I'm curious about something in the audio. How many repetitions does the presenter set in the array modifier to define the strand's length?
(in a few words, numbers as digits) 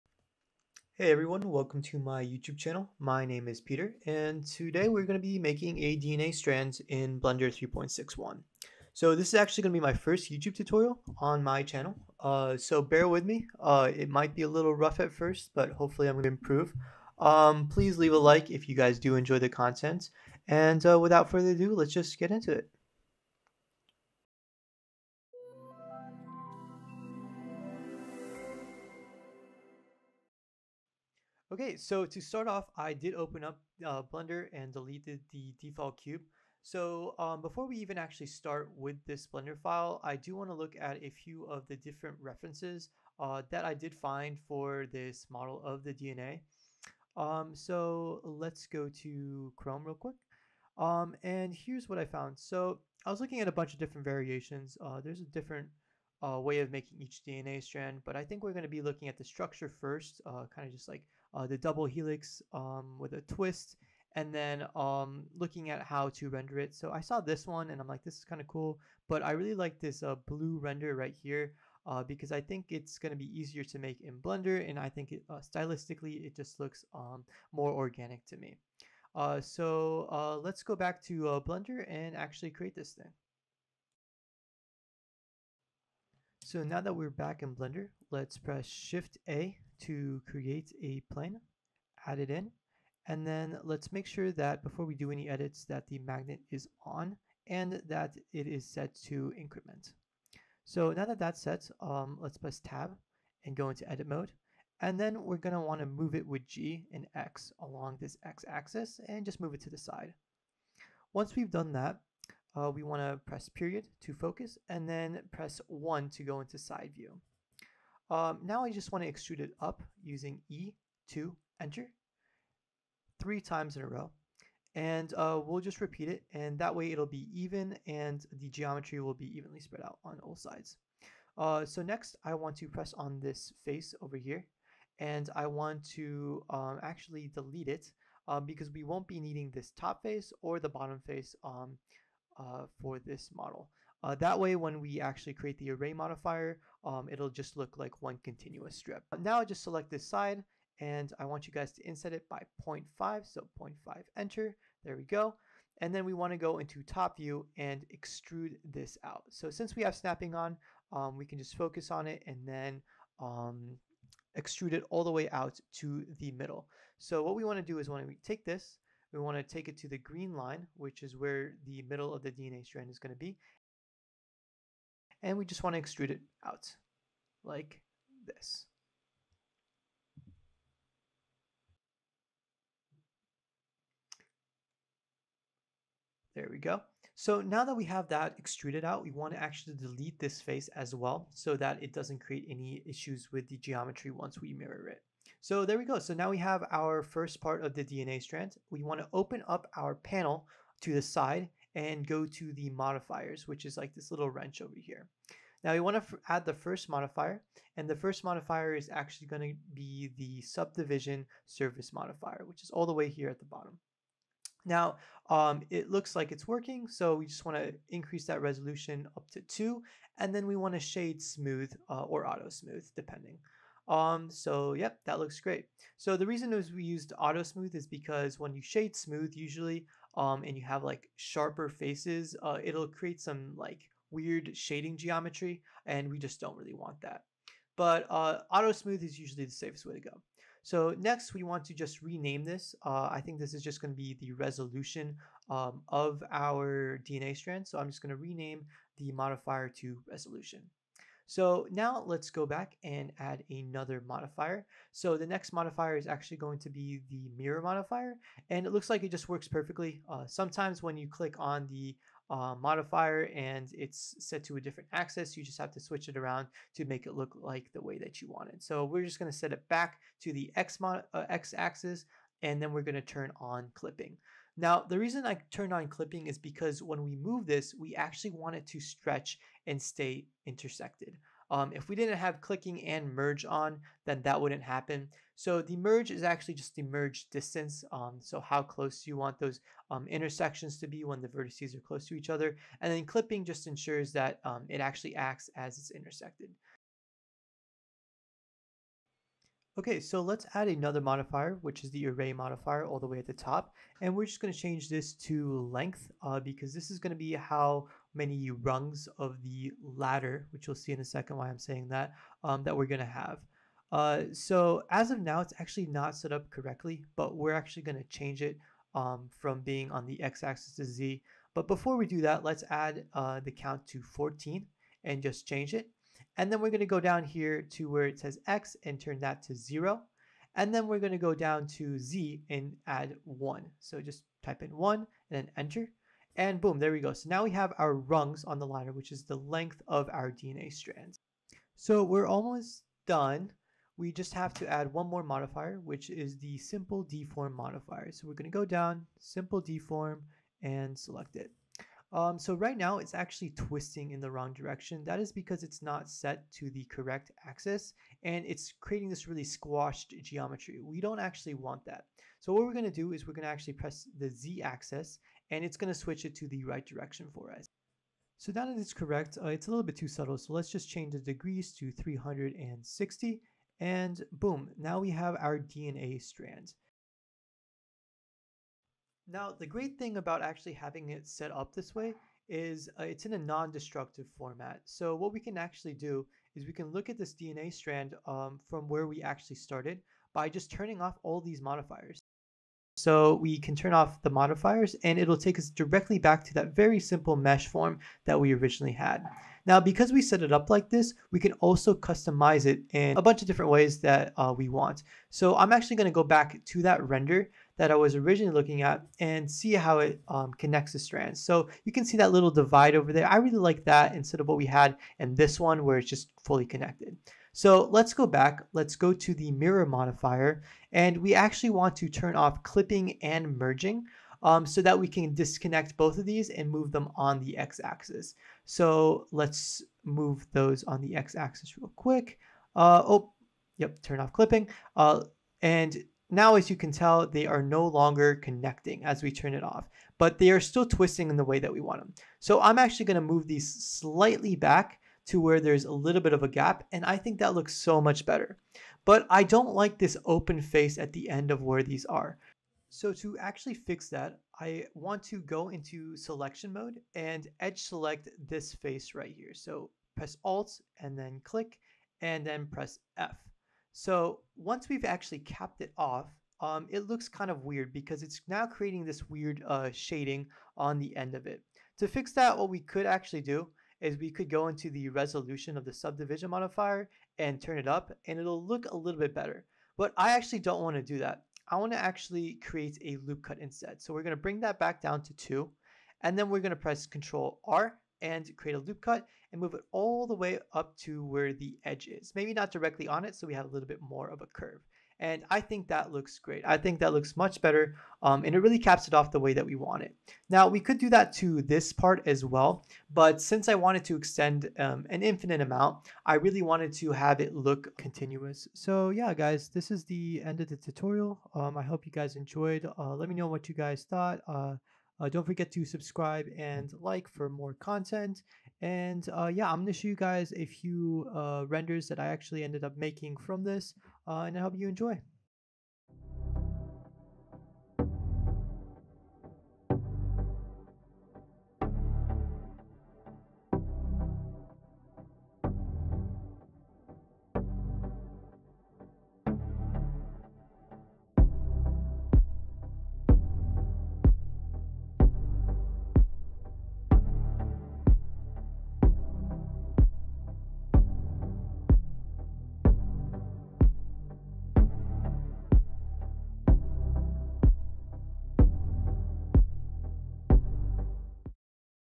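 14.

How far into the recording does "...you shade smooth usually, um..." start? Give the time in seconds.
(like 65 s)
228 s.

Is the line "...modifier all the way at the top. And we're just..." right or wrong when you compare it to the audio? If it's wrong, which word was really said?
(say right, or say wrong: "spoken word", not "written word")
right.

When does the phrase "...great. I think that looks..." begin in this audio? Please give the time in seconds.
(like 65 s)
496 s.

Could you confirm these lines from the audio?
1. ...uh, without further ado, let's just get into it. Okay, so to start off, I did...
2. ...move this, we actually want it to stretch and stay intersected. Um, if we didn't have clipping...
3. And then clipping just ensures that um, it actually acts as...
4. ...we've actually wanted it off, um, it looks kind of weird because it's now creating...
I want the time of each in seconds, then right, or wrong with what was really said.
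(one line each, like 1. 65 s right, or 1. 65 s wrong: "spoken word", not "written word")
1. 20 s right
2. 277 s right
3. 292 s right
4. 464 s wrong: "capped", not "wanted".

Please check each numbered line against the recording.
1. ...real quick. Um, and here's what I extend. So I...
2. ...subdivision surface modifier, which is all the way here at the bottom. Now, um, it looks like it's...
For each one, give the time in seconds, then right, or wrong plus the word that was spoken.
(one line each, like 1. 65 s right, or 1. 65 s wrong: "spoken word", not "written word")
1. 49 s wrong: "found", not "extend"
2. 210 s right.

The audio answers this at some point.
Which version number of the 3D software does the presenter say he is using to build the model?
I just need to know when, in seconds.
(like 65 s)
7 s.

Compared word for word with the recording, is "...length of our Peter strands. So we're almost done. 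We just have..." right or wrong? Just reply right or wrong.
wrong.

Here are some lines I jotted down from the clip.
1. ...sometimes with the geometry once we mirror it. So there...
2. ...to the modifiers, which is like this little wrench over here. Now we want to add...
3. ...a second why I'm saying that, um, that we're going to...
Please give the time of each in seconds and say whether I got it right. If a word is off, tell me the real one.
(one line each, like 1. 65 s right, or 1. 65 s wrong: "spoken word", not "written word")
1. 192 s wrong: "issues", not "sometimes"
2. 202 s right
3. 310 s right.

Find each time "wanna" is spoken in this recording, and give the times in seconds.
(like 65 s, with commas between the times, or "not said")
105 s, 112 s, 156 s, 167 s.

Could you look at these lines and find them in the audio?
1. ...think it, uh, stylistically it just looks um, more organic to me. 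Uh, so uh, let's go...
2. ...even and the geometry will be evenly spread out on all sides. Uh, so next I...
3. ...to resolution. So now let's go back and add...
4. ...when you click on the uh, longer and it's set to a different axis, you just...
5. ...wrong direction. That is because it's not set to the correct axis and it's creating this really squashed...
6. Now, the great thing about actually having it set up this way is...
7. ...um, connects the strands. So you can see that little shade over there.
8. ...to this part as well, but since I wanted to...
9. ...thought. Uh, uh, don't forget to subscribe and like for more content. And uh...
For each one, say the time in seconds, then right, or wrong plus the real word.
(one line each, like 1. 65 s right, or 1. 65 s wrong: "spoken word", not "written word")
1. 74 s right
2. 127 s right
3. 249 s right
4. 260 s wrong: "modifier", not "longer"
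5. 354 s right
6. 379 s right
7. 410 s wrong: "divide", not "shade"
8. 501 s right
9. 514 s right.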